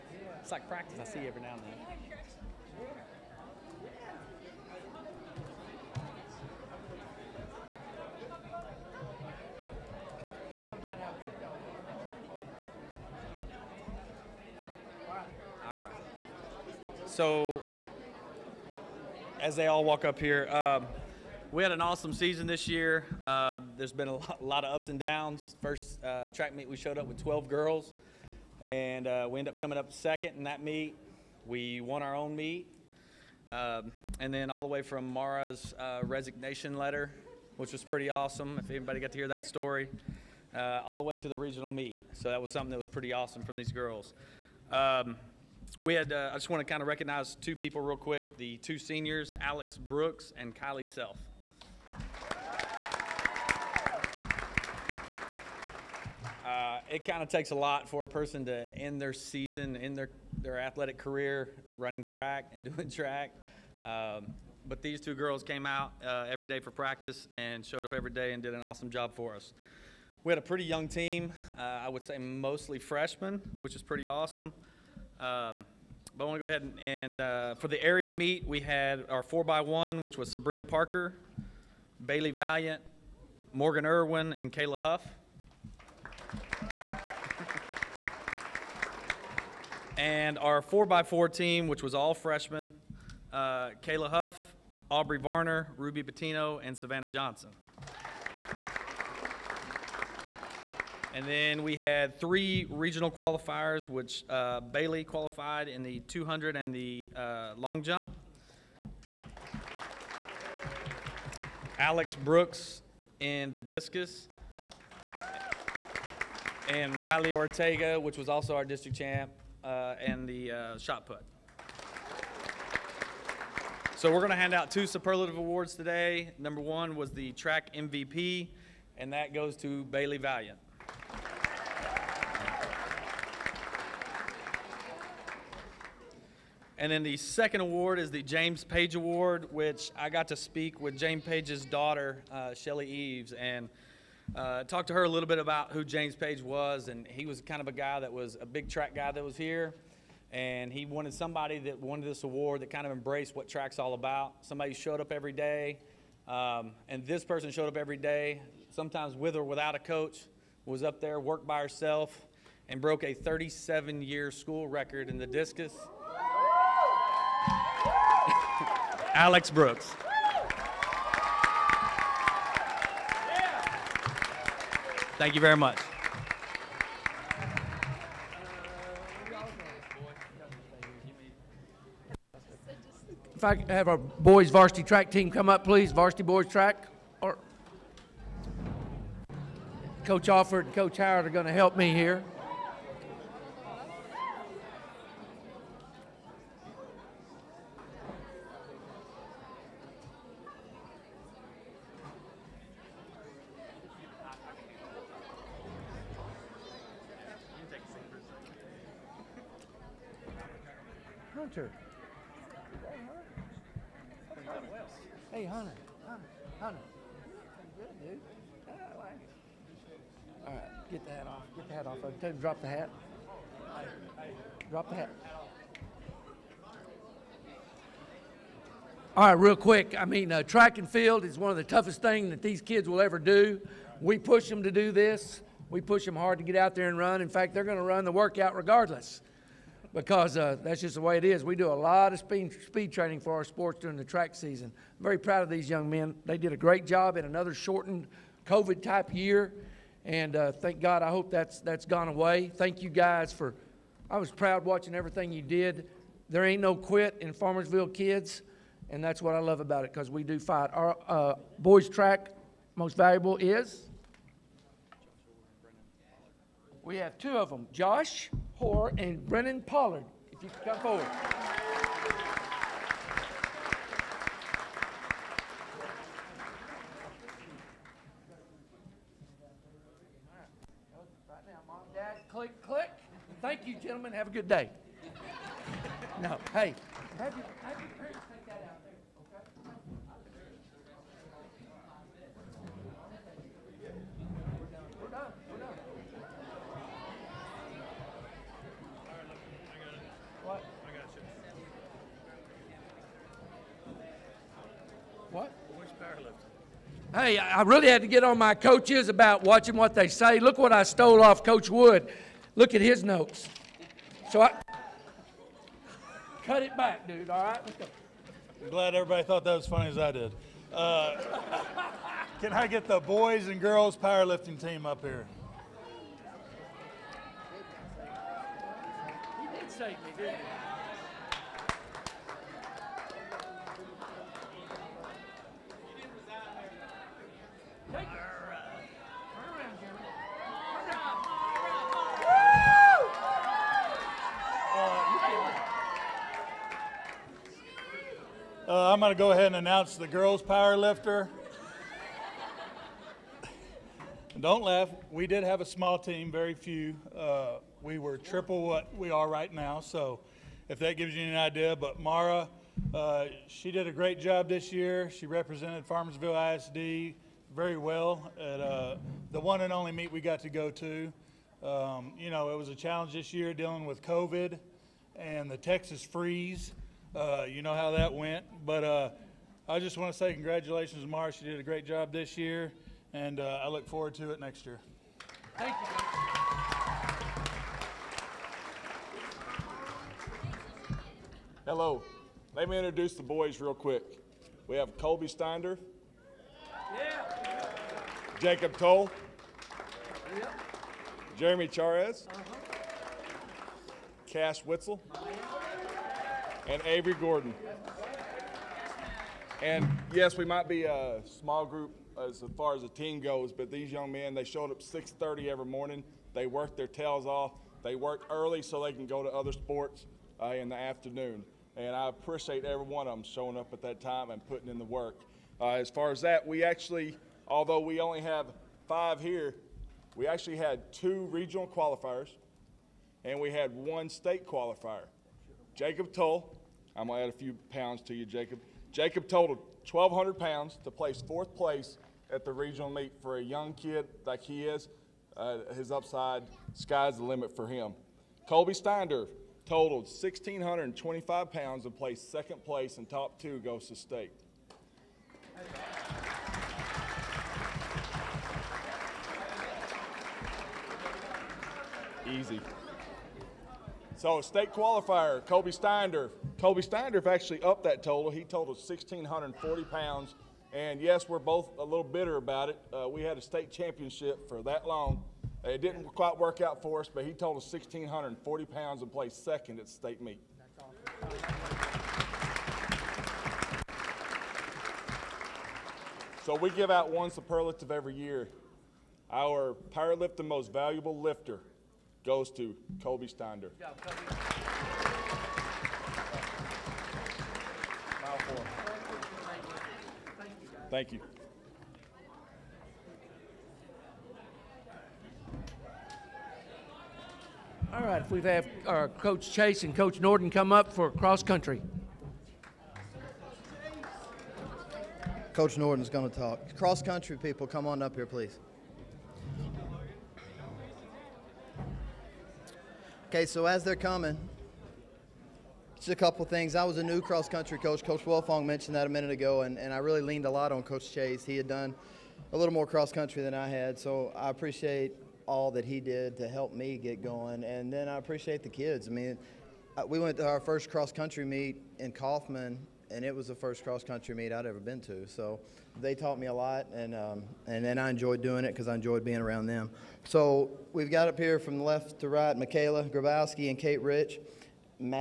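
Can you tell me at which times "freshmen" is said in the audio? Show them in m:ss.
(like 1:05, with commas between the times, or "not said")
1:12, 1:32.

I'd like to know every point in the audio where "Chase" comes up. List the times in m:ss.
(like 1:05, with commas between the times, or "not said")
8:29, 8:51.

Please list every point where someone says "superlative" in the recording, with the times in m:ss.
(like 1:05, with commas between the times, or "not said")
2:04, 8:07.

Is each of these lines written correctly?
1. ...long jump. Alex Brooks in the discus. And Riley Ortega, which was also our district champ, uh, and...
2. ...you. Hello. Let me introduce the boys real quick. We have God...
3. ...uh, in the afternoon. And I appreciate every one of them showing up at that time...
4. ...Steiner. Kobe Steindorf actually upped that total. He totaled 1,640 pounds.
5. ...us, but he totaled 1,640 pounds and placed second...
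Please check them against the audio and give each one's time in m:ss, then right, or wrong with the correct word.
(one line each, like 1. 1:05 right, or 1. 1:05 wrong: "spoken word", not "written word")
1. 1:47 right
2. 6:25 wrong: "Colby", not "God"
3. 7:00 right
4. 7:45 right
5. 7:57 right.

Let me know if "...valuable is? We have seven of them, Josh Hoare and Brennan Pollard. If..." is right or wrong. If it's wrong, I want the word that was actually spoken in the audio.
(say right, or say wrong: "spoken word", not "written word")
wrong: "two", not "seven".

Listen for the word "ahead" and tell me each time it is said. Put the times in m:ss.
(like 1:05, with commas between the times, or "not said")
1:16, 5:49.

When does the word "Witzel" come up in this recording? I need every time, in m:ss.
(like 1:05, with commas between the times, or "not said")
6:44.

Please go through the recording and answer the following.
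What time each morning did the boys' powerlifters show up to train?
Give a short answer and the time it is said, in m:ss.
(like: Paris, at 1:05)
6:30, at 6:54.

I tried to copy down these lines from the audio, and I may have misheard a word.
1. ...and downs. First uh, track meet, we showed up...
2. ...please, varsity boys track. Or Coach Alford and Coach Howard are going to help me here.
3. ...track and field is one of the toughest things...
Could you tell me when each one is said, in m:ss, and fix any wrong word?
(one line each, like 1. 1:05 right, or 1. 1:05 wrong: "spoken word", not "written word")
1. 0:24 right
2. 3:05 right
3. 3:50 right.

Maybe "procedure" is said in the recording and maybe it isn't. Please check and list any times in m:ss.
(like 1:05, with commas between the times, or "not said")
not said.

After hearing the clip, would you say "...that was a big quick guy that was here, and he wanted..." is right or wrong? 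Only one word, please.
wrong.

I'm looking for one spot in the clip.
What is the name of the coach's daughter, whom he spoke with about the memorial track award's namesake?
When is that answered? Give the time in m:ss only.
2:22.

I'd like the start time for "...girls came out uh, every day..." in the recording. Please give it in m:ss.
1:05.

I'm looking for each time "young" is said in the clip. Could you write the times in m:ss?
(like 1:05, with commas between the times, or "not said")
1:10, 4:05, 6:53, 7:23.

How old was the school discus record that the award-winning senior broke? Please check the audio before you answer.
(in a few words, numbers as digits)
37 years.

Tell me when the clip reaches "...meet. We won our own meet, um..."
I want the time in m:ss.
0:30.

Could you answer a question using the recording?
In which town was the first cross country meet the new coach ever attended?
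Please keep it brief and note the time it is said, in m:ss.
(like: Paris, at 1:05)
Kaufman, at 9:02.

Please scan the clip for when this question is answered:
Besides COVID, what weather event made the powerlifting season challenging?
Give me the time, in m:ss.
6:15.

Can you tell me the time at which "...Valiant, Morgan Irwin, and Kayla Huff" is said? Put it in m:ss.
1:22.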